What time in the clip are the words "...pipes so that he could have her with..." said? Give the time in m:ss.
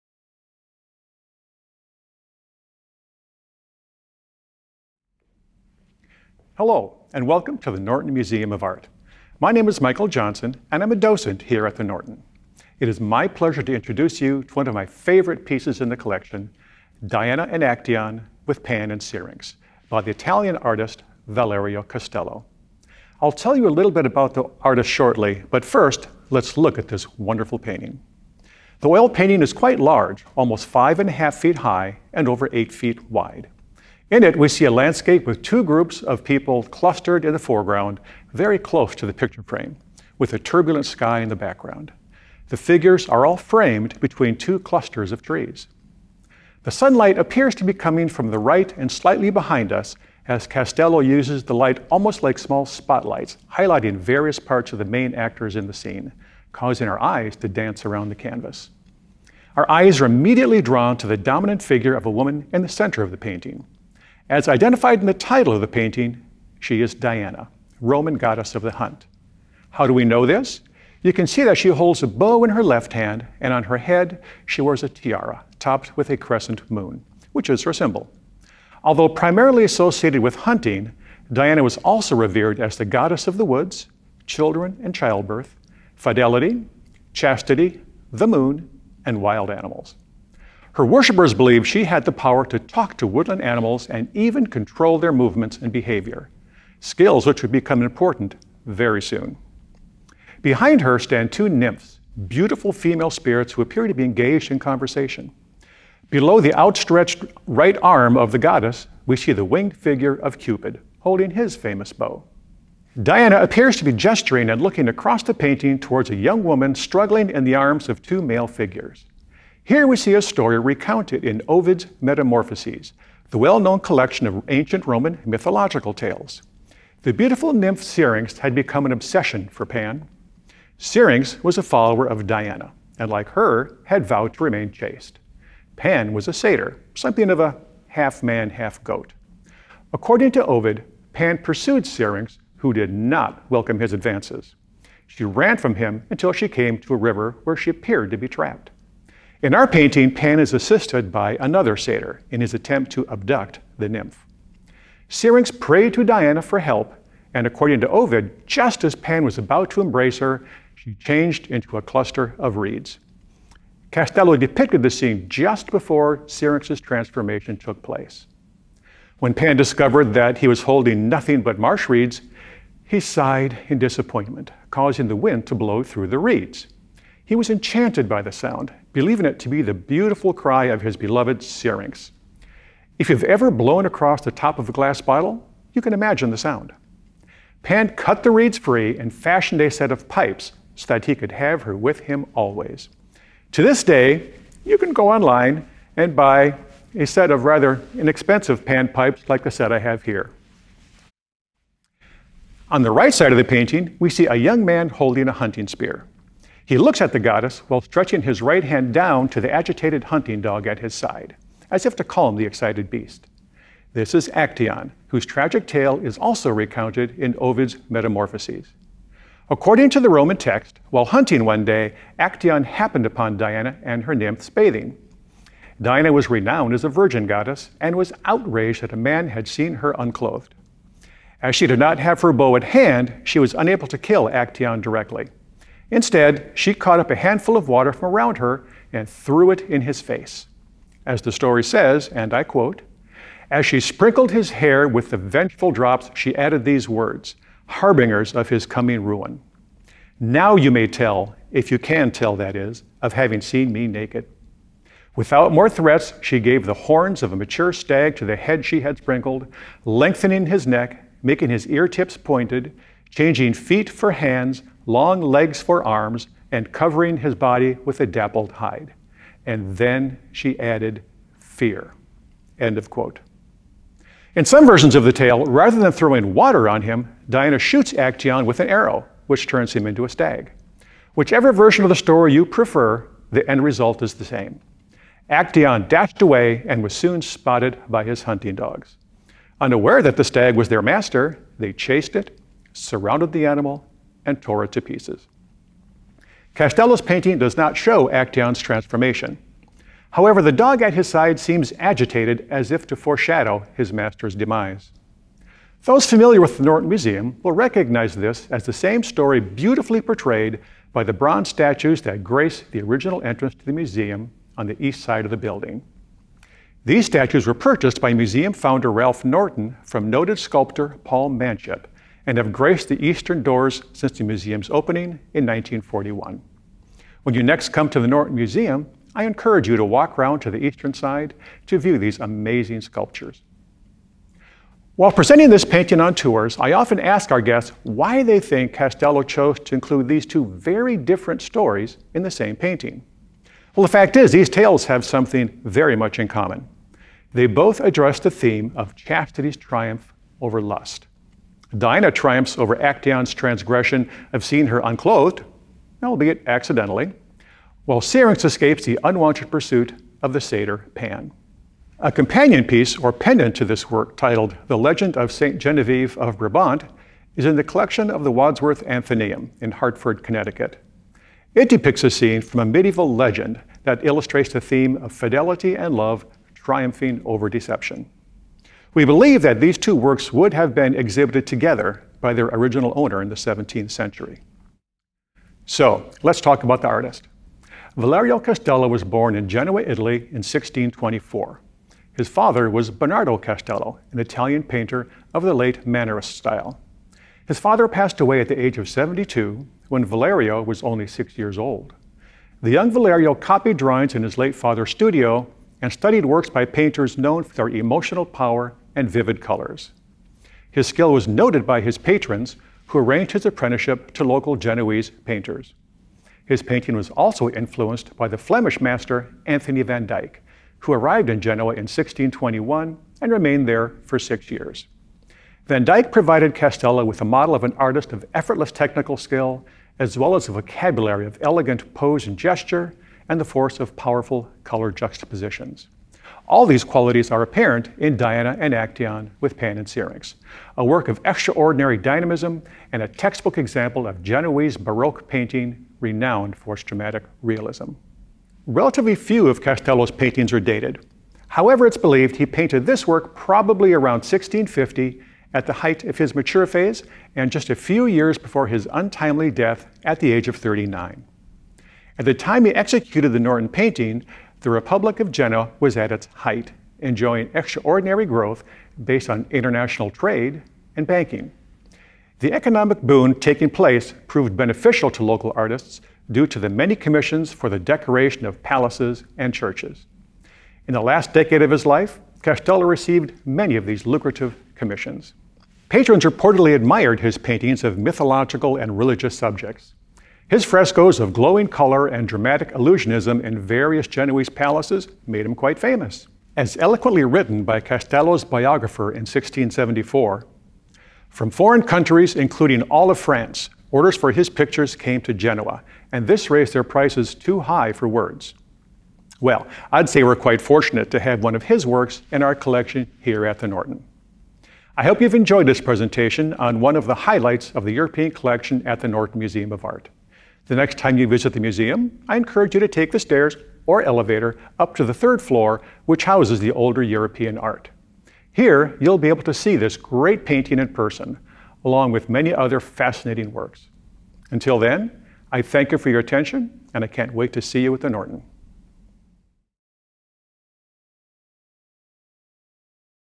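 3:10.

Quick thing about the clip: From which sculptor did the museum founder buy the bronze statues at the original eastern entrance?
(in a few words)
Paul Manship.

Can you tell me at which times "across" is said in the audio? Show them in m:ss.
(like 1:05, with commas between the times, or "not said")
1:54, 3:03.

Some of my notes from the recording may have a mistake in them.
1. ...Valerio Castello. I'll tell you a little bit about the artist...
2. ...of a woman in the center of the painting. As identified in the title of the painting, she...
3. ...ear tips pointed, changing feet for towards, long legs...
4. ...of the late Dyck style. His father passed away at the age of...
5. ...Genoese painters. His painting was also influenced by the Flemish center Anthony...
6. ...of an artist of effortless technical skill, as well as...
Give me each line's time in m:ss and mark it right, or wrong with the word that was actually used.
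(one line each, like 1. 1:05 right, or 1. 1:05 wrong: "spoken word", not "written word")
1. 0:21 right
2. 1:01 right
3. 4:21 wrong: "hands", not "towards"
4. 6:35 wrong: "Mannerist", not "Dyck"
5. 6:54 wrong: "master", not "center"
6. 7:07 right.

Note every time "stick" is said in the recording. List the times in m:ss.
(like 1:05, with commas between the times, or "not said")
not said.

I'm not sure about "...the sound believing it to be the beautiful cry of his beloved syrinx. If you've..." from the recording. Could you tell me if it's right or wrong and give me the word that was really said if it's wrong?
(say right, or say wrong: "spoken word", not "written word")
right.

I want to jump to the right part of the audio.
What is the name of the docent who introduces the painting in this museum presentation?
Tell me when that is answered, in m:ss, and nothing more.
0:09.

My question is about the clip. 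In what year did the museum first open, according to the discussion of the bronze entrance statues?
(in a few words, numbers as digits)
1941.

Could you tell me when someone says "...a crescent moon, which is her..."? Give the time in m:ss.
1:16.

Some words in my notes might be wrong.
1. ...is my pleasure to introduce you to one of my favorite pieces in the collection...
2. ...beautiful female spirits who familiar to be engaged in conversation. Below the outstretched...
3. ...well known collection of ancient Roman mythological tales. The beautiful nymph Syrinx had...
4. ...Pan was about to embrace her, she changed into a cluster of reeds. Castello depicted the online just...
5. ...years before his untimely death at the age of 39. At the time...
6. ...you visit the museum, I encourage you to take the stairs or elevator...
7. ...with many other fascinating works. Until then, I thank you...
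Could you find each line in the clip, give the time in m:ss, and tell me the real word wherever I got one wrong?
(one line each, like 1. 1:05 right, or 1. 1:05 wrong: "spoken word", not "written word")
1. 0:12 right
2. 1:42 wrong: "appear", not "familiar"
3. 2:03 right
4. 2:38 wrong: "scene", not "online"
5. 7:38 right
6. 8:41 right
7. 8:52 right.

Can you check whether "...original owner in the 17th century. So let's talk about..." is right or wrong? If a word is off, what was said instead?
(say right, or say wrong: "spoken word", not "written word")
right.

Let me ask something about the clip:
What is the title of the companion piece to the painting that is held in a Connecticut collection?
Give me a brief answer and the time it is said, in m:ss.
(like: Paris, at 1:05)
The Legend of St. Genevieve of Brabant, at 6:04.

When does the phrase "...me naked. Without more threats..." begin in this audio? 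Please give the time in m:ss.
4:13.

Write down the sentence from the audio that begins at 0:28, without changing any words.
The oil painting is quite large, almost five and a half feet high and over eight feet wide.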